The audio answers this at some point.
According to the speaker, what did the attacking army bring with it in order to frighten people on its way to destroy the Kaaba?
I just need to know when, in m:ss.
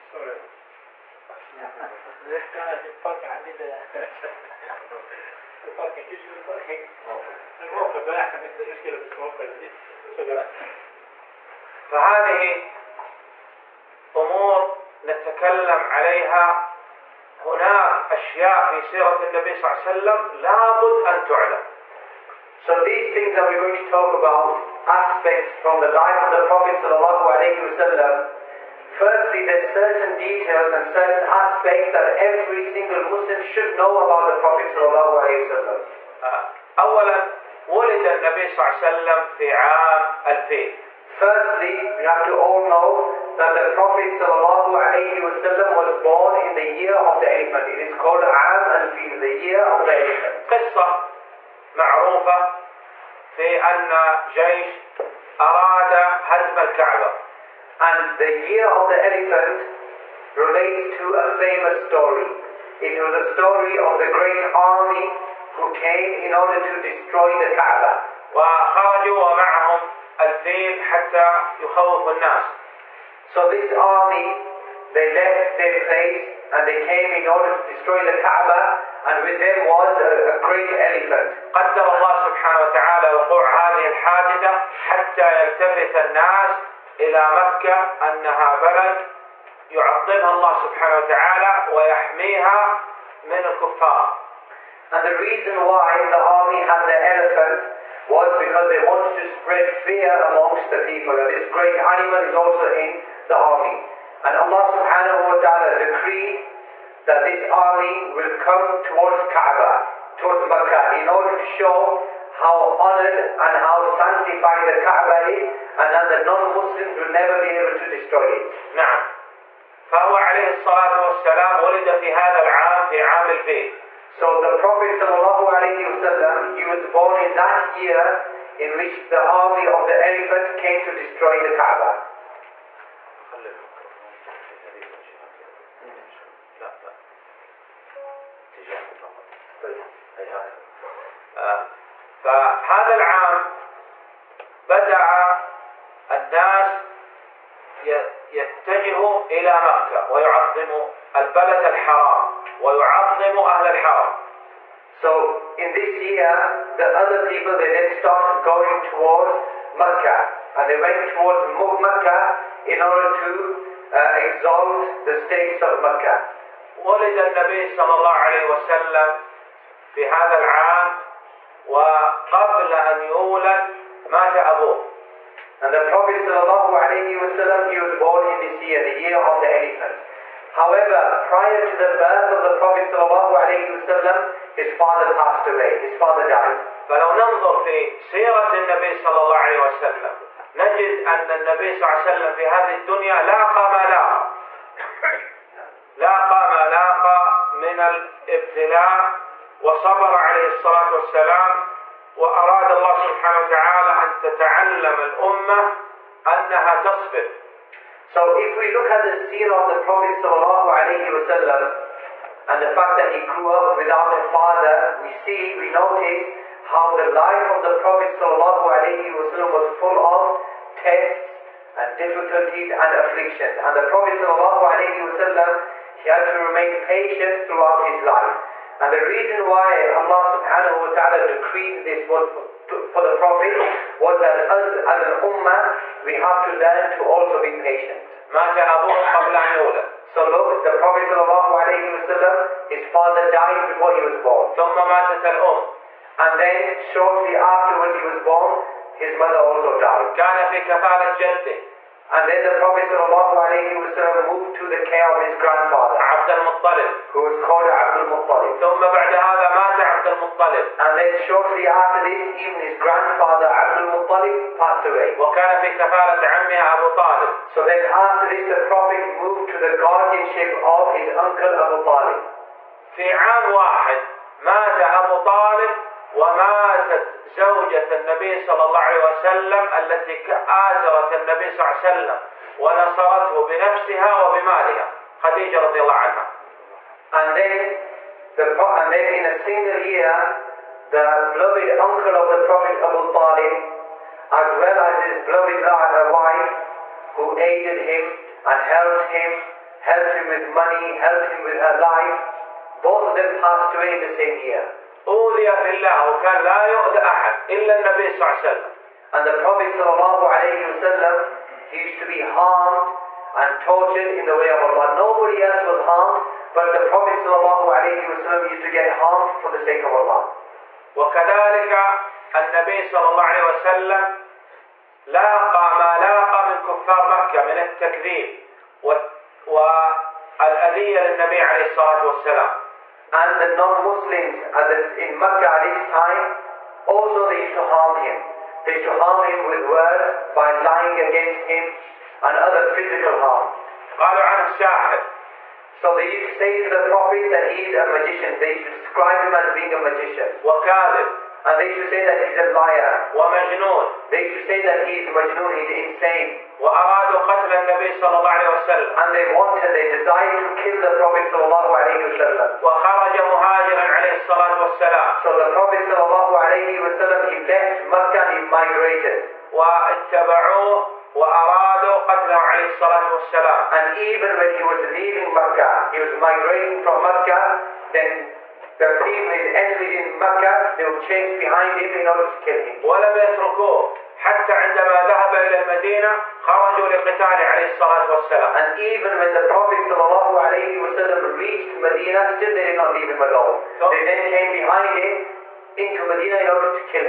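1:20.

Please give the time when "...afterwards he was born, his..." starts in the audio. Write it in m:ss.
4:07.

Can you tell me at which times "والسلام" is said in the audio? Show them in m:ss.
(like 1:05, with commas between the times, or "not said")
2:00, 3:20, 5:32, 6:04, 6:13, 6:28.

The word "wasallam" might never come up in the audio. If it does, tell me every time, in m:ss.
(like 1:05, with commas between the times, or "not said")
0:26, 0:34, 2:05, 2:57, 3:03, 3:31, 4:01.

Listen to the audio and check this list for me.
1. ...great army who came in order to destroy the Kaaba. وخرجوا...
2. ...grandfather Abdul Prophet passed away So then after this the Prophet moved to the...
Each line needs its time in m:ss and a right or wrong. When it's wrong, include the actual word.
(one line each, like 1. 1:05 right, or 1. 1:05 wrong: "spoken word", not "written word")
1. 1:04 right
2. 4:22 wrong: "Muttalib", not "Prophet".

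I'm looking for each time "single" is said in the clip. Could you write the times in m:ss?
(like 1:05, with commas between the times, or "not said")
0:32, 4:49.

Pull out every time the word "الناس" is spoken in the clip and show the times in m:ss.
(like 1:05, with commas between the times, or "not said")
1:12, 1:26, 2:26.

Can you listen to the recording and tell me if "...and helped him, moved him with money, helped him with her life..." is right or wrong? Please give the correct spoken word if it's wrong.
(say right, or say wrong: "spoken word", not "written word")
wrong: "helped", not "moved".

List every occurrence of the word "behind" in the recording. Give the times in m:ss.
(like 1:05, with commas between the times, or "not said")
6:21, 6:34.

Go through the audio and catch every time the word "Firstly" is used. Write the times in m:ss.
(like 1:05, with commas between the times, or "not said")
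0:28, 0:41.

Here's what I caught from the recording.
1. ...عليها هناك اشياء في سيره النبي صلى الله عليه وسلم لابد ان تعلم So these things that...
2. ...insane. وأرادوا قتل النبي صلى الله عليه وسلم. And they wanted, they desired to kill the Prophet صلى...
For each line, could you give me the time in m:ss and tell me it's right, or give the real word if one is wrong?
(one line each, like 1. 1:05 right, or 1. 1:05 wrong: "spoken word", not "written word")
1. 0:15 right
2. 5:55 right.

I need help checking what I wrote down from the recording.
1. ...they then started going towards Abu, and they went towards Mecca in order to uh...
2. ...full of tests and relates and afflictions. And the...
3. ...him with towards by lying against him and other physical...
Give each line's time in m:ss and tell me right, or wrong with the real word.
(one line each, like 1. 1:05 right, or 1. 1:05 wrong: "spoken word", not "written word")
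1. 2:37 wrong: "Mecca", not "Abu"
2. 3:39 wrong: "difficulties", not "relates"
3. 5:39 wrong: "words", not "towards".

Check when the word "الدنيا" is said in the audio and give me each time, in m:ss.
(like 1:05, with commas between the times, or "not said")
3:12.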